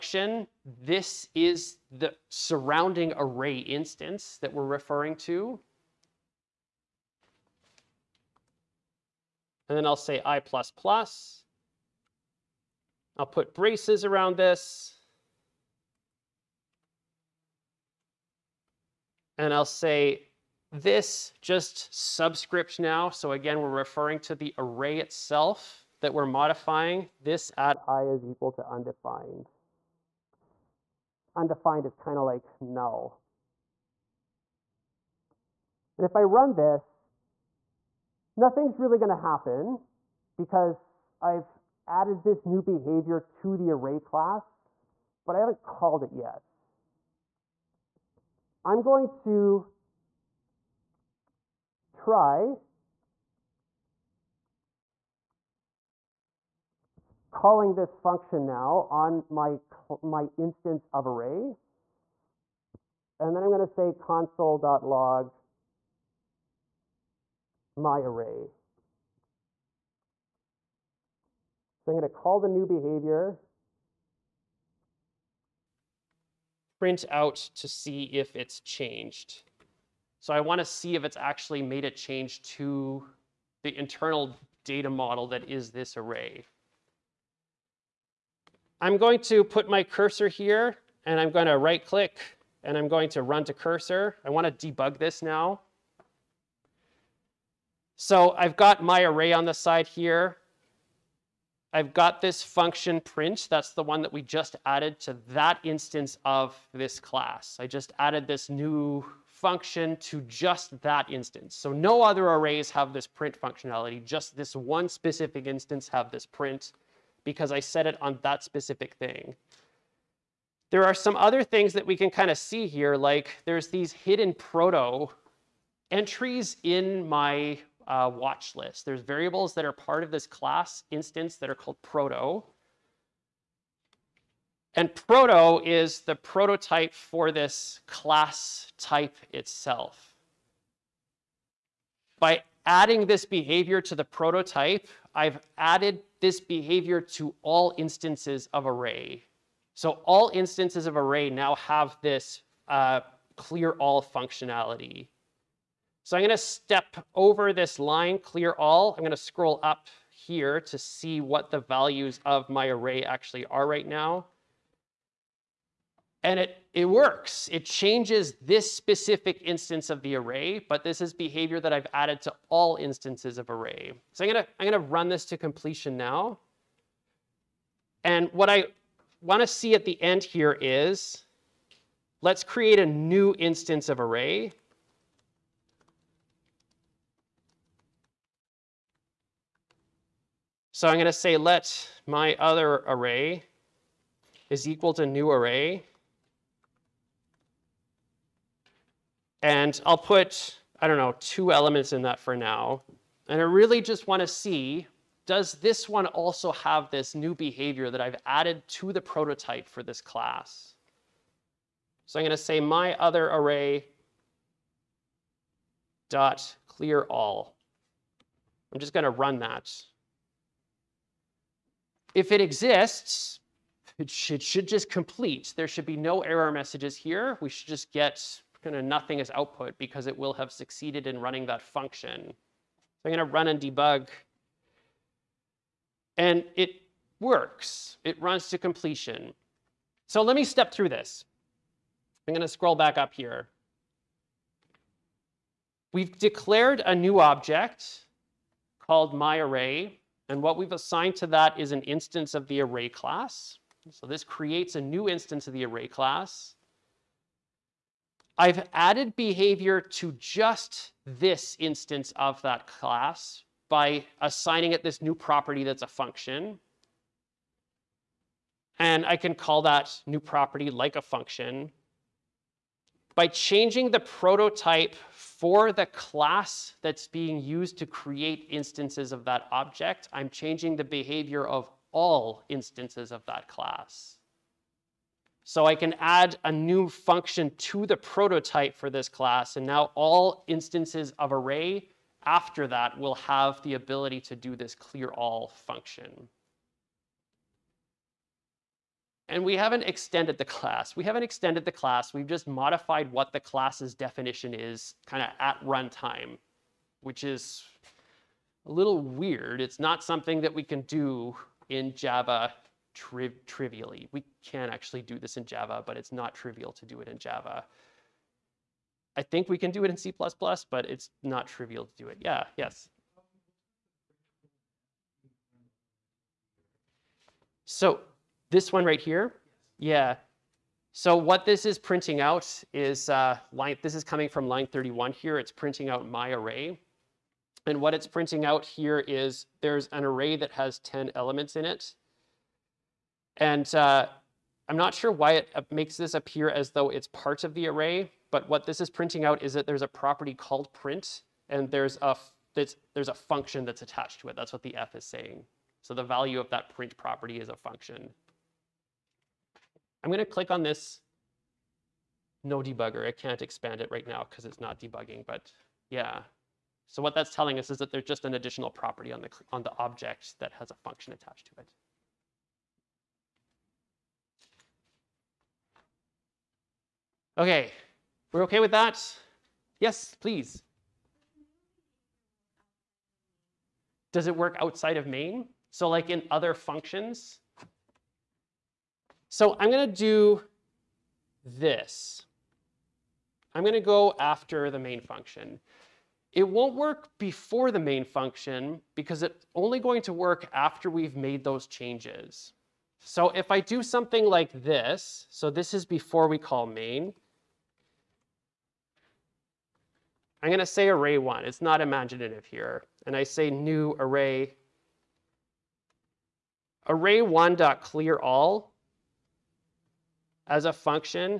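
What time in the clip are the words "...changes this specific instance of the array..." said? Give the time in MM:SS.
02:47.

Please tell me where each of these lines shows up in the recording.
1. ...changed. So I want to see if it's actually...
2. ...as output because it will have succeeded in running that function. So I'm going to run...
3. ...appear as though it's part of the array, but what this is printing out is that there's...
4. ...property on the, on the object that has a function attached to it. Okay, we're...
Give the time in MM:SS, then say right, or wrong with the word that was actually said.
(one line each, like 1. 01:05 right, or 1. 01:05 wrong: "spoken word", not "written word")
1. 01:18 right
2. 03:49 right
3. 05:46 right
4. 06:08 right.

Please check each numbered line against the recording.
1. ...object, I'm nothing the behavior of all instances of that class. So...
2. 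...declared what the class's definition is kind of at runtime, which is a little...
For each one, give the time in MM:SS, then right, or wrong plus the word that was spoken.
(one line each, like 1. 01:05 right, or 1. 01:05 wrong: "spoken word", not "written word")
1. 04:39 wrong: "changing", not "nothing"
2. 05:02 wrong: "modified", not "declared".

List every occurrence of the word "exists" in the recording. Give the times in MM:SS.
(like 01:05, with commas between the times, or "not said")
03:42.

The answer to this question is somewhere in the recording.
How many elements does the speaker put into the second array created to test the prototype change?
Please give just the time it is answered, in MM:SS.
03:21.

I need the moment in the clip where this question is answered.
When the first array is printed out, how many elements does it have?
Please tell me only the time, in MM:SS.
05:40.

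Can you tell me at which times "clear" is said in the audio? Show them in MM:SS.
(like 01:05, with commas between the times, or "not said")
02:33, 02:38, 03:36, 04:54, 06:57.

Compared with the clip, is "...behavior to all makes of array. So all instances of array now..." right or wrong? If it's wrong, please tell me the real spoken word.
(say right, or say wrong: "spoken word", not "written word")
wrong: "instances", not "makes".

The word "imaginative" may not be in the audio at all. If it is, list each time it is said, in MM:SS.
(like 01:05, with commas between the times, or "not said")
06:51.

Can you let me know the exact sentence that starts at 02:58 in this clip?
And what I wanna see at the end here is, let's create a new instance of array.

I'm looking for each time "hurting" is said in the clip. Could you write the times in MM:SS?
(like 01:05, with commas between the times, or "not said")
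not said.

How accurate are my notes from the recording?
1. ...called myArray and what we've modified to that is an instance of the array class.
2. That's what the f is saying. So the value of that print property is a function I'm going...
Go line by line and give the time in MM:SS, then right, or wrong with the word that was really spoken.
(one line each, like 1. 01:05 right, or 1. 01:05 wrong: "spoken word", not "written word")
1. 04:08 wrong: "assigned", not "modified"
2. 05:54 right.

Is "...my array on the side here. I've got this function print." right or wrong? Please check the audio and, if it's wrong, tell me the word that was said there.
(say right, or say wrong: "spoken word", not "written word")
right.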